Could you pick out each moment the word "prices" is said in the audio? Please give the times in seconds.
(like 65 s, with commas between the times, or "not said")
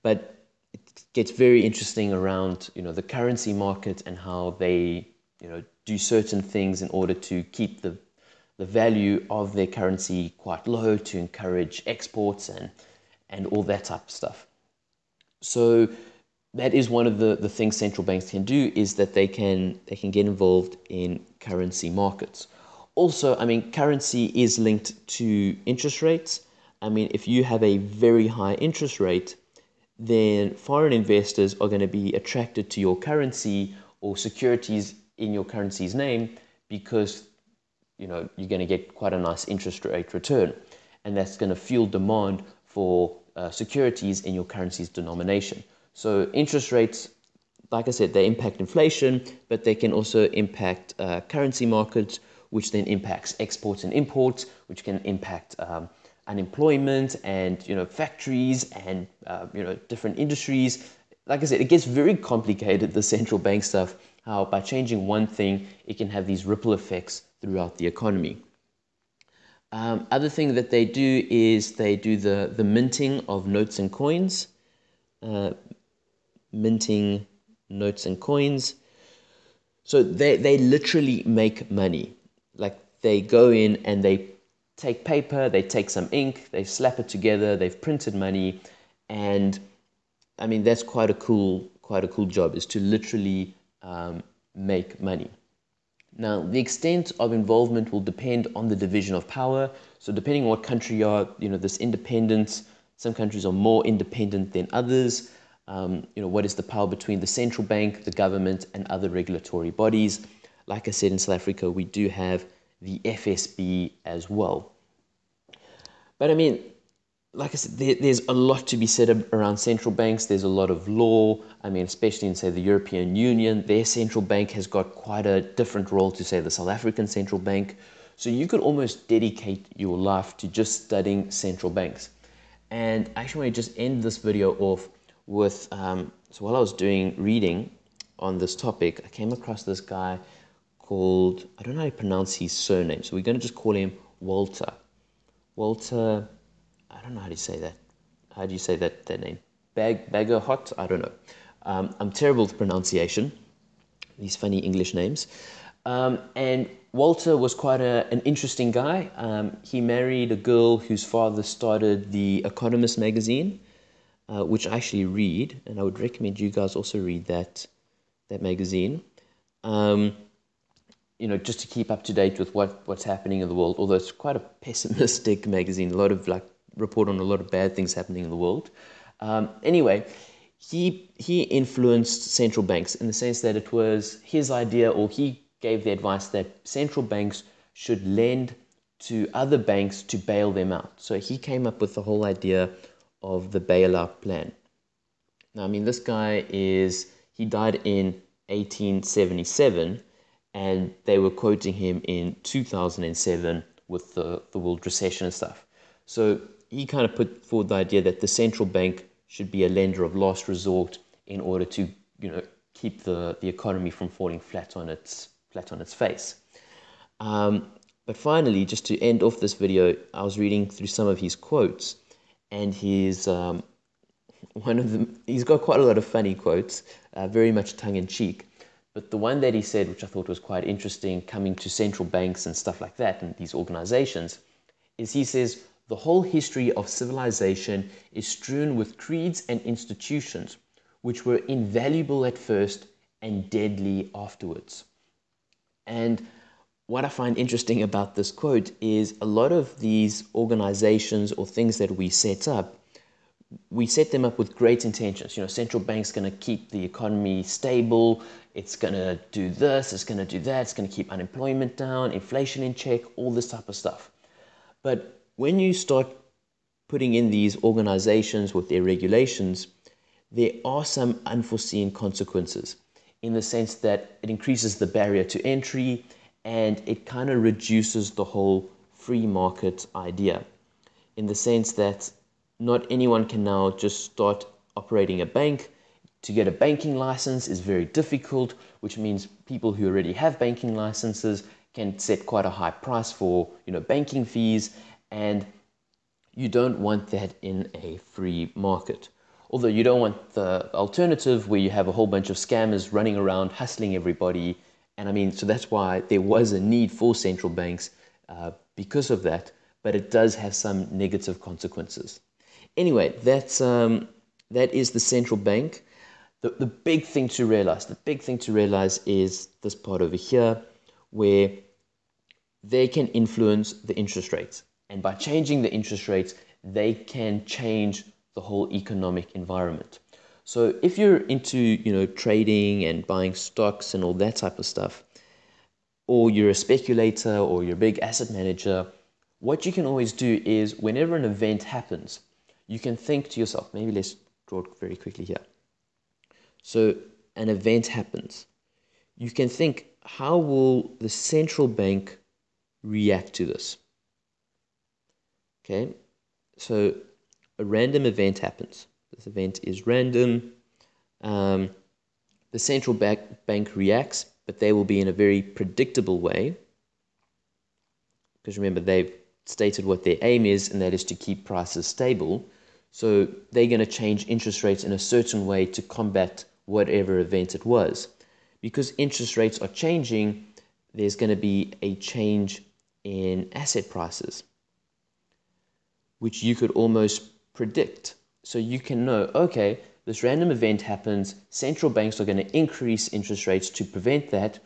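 292 s, 371 s, 383 s.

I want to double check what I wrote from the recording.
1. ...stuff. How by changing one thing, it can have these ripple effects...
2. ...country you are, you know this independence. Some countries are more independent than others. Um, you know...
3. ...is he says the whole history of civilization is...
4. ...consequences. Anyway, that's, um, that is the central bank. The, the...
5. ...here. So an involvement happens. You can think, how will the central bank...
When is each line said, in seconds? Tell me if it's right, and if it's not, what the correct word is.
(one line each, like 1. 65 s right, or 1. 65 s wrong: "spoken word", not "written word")
1. 63 s right
2. 100 s right
3. 234 s right
4. 311 s right
5. 345 s wrong: "event", not "involvement".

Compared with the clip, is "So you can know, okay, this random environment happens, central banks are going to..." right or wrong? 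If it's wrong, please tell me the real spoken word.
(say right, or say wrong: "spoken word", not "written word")
wrong: "event", not "environment".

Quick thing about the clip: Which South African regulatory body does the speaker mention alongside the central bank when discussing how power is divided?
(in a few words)
FSB.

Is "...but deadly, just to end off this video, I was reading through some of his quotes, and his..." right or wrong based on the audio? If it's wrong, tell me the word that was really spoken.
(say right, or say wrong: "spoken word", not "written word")
wrong: "finally", not "deadly".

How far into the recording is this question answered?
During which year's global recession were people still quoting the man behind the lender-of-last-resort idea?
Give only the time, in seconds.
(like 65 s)
202 s.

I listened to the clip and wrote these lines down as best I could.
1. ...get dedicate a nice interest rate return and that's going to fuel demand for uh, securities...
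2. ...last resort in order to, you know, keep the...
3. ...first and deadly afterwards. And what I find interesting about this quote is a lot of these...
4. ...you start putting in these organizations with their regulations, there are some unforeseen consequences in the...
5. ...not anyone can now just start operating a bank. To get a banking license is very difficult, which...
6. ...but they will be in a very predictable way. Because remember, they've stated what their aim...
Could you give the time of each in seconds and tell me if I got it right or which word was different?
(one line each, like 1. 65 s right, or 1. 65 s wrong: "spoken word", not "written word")
1. 38 s wrong: "quite", not "dedicate"
2. 210 s right
3. 242 s right
4. 265 s right
5. 282 s right
6. 364 s right.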